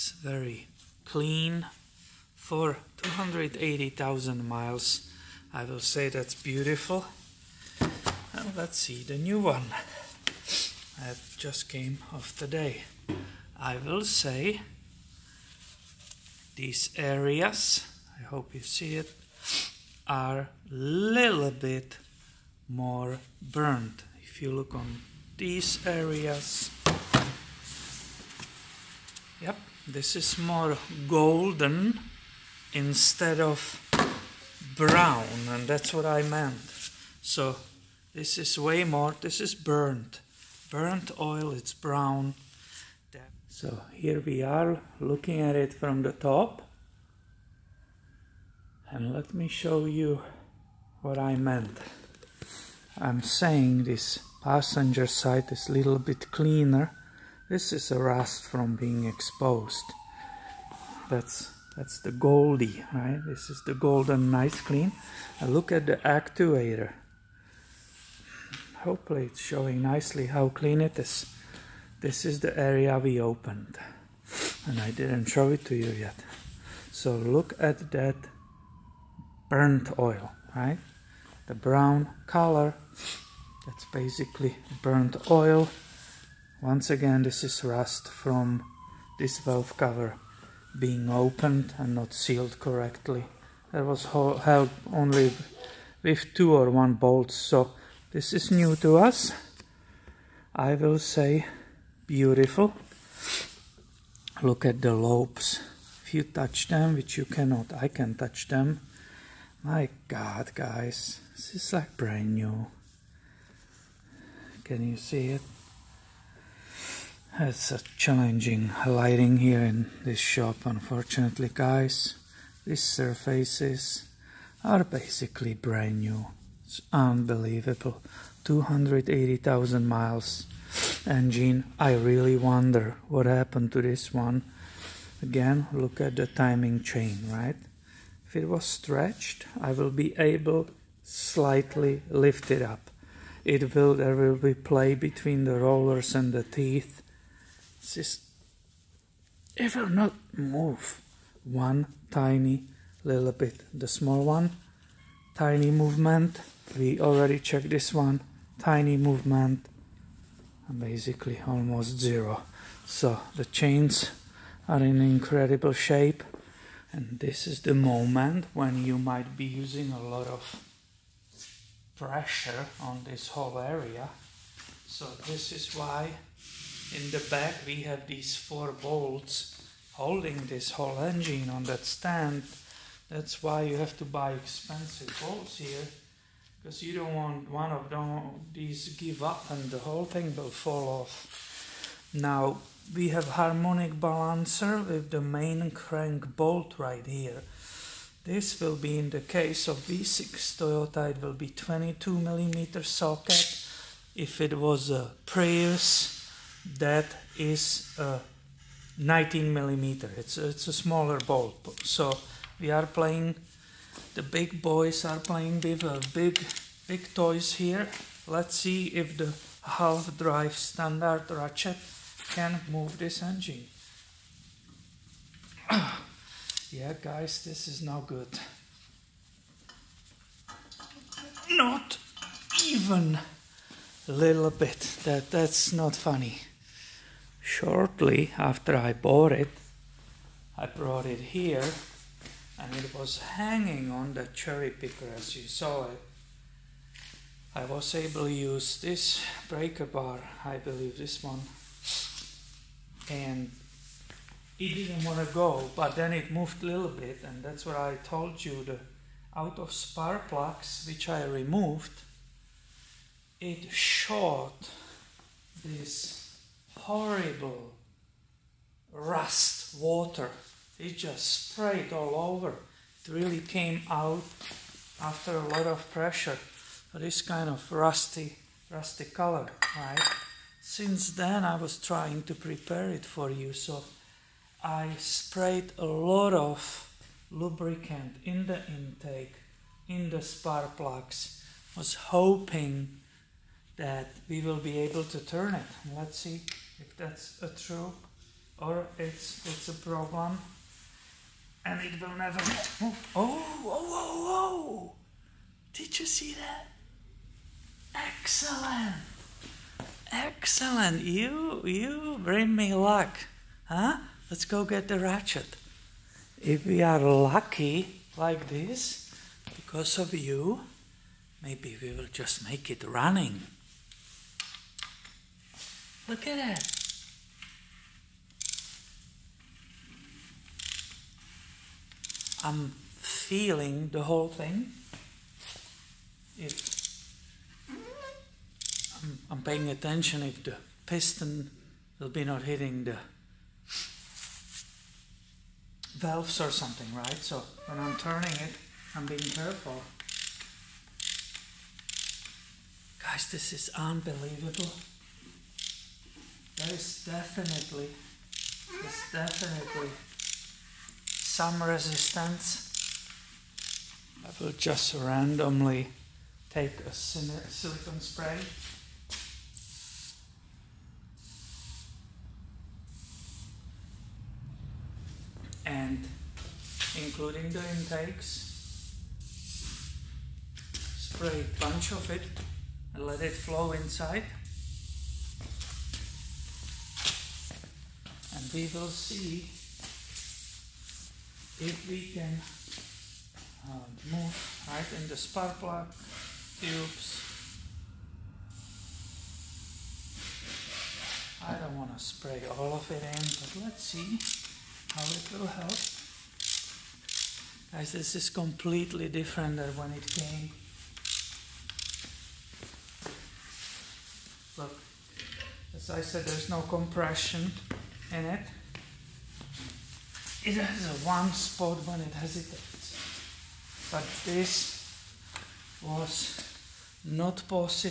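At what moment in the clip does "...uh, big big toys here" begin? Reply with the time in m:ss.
3:35.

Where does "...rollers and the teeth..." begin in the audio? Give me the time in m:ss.
2:25.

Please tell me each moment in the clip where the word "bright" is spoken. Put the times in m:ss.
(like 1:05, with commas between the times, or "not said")
not said.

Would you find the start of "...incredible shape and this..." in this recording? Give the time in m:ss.
2:44.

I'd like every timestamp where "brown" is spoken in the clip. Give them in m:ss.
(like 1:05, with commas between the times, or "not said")
0:34, 0:41, 1:21.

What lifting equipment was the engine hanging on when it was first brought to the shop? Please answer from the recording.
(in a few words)
Cherry picker.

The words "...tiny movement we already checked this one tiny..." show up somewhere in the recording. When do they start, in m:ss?
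2:35.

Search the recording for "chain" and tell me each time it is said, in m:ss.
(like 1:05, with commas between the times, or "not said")
2:16, 2:43.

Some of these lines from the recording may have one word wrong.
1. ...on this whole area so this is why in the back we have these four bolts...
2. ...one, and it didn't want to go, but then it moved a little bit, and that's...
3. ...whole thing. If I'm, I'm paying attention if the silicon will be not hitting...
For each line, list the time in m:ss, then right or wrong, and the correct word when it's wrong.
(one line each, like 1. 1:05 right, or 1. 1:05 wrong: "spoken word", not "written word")
1. 2:52 right
2. 4:11 right
3. 5:34 wrong: "piston", not "silicon".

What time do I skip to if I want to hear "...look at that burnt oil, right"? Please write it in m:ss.
1:17.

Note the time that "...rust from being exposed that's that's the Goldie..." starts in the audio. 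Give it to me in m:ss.
0:57.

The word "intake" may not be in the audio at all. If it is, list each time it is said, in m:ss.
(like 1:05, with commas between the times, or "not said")
4:48, 6:17.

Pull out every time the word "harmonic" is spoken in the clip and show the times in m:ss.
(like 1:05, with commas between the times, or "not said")
3:13.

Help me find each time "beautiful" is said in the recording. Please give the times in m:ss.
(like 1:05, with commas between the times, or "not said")
0:06, 1:42.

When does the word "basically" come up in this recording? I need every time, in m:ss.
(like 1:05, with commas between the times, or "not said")
1:23, 2:04, 2:40.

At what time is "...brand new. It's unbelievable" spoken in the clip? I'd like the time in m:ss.
2:05.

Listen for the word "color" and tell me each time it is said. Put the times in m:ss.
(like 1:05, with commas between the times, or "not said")
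1:22, 4:39.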